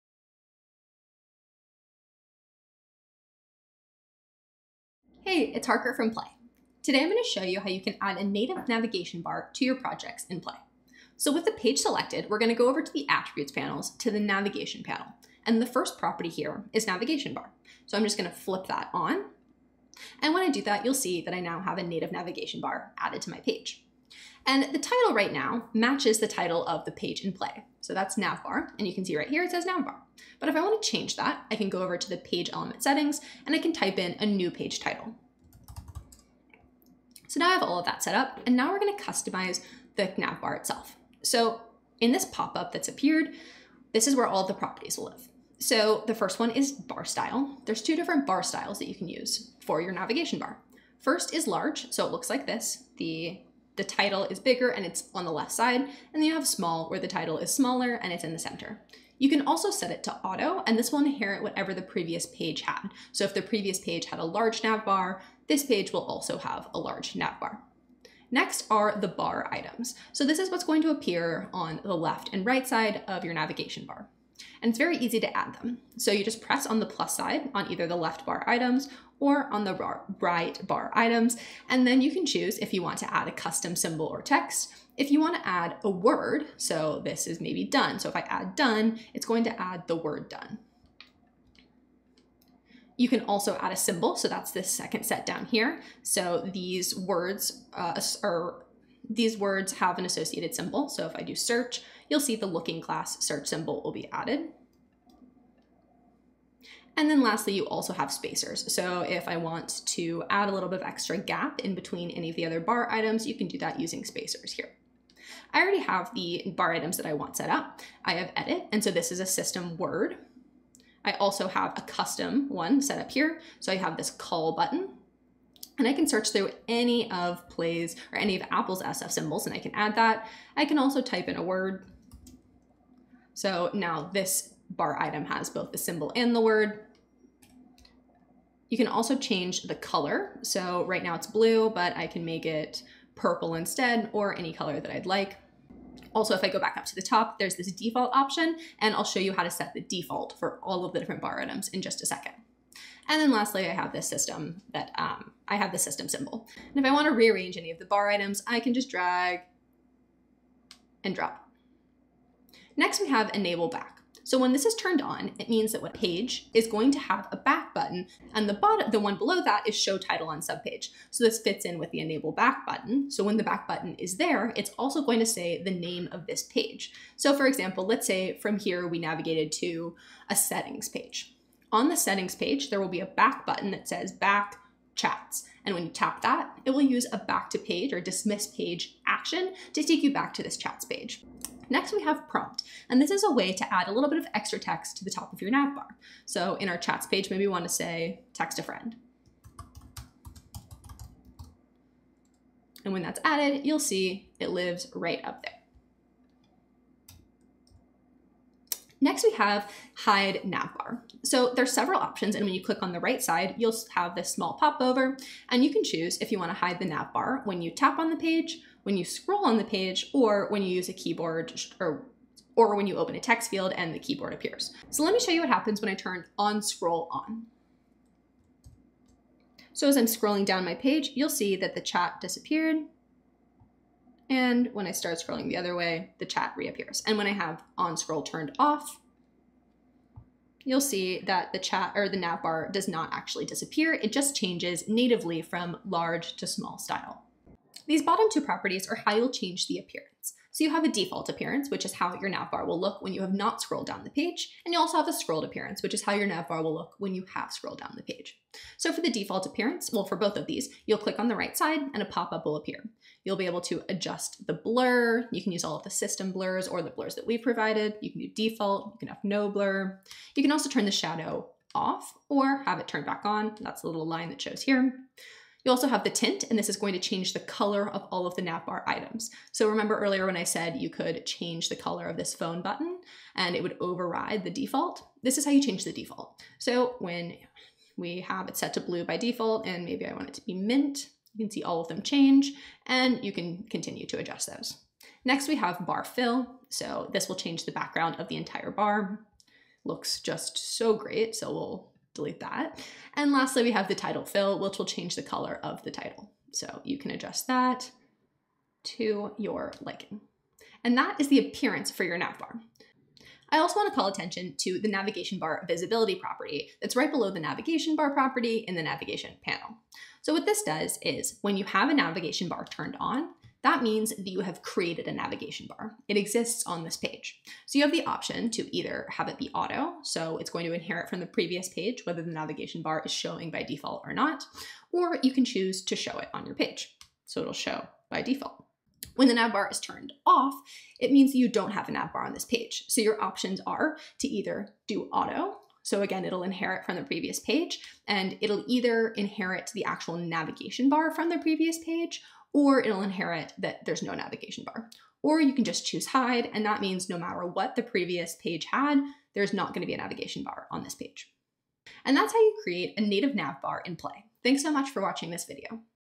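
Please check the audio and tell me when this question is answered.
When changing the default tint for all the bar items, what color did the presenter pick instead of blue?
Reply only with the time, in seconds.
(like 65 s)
290 s.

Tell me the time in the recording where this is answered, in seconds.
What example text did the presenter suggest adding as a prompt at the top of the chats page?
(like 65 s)
198 s.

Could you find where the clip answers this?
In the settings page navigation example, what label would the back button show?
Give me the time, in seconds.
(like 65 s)
184 s.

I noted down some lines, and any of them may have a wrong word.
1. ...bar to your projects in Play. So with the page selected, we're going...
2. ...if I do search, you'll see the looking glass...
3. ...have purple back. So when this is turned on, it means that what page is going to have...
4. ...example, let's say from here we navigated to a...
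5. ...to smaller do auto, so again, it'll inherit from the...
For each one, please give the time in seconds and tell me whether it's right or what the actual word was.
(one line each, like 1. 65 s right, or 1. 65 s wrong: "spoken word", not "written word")
1. 9 s right
2. 101 s right
3. 163 s wrong: "enable", not "purple"
4. 177 s right
5. 344 s wrong: "either", not "smaller".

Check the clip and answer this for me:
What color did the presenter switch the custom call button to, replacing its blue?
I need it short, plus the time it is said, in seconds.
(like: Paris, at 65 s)
Purple, at 143 s.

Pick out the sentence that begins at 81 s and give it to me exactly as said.
And then you can choose if you want to add a custom symbol or text.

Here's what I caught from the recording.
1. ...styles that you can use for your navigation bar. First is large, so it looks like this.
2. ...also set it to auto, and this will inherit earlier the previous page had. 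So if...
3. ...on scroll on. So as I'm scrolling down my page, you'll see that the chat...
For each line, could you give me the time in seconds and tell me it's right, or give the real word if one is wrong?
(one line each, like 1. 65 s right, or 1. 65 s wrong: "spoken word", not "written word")
1. 48 s right
2. 59 s wrong: "whatever", not "earlier"
3. 226 s right.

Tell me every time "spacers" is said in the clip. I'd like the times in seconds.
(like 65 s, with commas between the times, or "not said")
108 s, 114 s.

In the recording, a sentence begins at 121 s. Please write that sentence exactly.
I also have a custom one set up here.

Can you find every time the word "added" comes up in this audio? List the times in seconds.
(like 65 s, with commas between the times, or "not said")
22 s, 104 s, 203 s.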